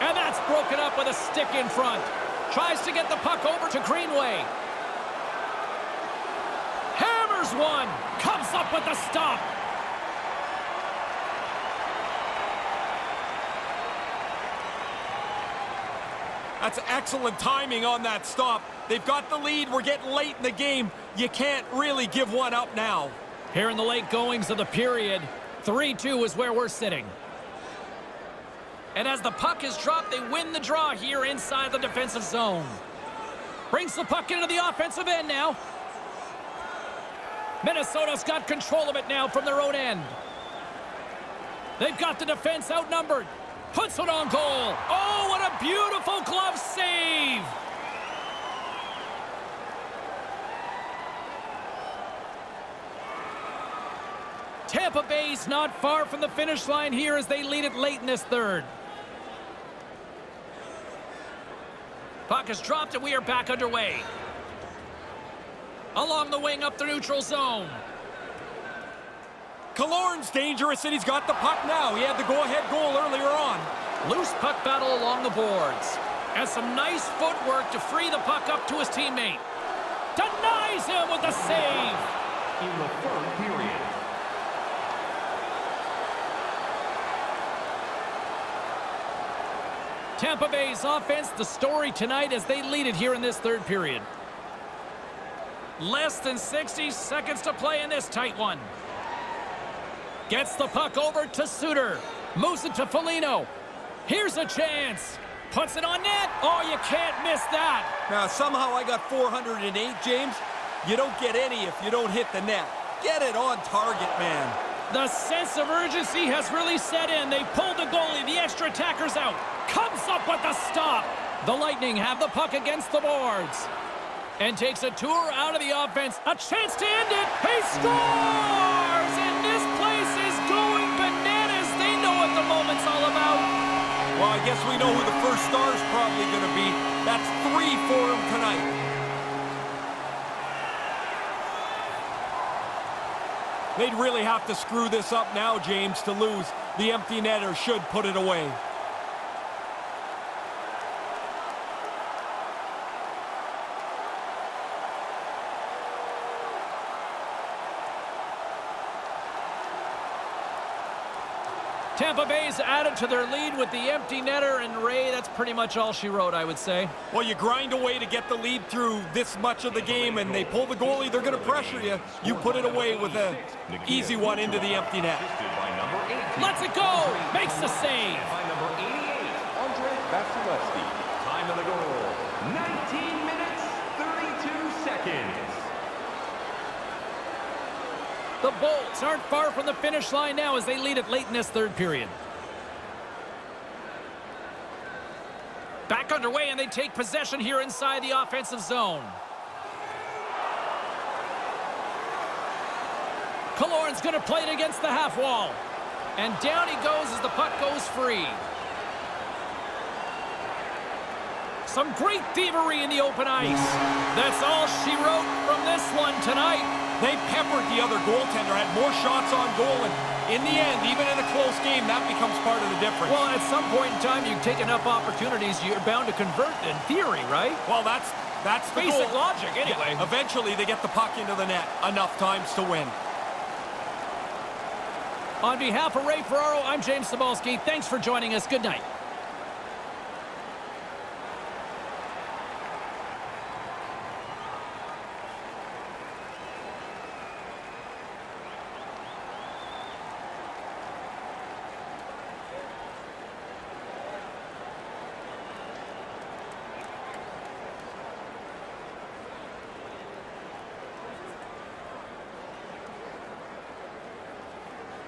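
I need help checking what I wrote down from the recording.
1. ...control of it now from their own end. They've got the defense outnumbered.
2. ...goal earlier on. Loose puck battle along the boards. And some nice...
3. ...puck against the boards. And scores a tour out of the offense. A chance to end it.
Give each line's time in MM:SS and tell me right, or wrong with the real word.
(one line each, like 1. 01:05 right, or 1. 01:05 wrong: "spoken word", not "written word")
1. 00:38 right
2. 01:12 right
3. 02:02 wrong: "takes", not "scores".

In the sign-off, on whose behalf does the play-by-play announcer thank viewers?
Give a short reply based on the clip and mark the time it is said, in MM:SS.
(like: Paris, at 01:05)
Ray Ferraro, at 03:56.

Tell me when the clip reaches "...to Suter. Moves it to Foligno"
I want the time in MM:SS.
01:41.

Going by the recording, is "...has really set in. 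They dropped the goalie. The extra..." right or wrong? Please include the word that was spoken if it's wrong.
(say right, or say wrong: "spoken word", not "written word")
wrong: "pulled", not "dropped".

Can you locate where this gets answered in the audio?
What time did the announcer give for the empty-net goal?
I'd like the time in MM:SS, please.
03:02.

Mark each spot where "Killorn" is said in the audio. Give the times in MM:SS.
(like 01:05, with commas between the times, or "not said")
01:09, 03:23.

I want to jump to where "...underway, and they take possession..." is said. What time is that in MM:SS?
03:16.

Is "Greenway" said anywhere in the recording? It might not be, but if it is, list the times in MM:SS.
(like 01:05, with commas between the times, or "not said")
00:03.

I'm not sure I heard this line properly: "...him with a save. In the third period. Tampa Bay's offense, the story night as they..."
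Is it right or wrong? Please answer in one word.
wrong.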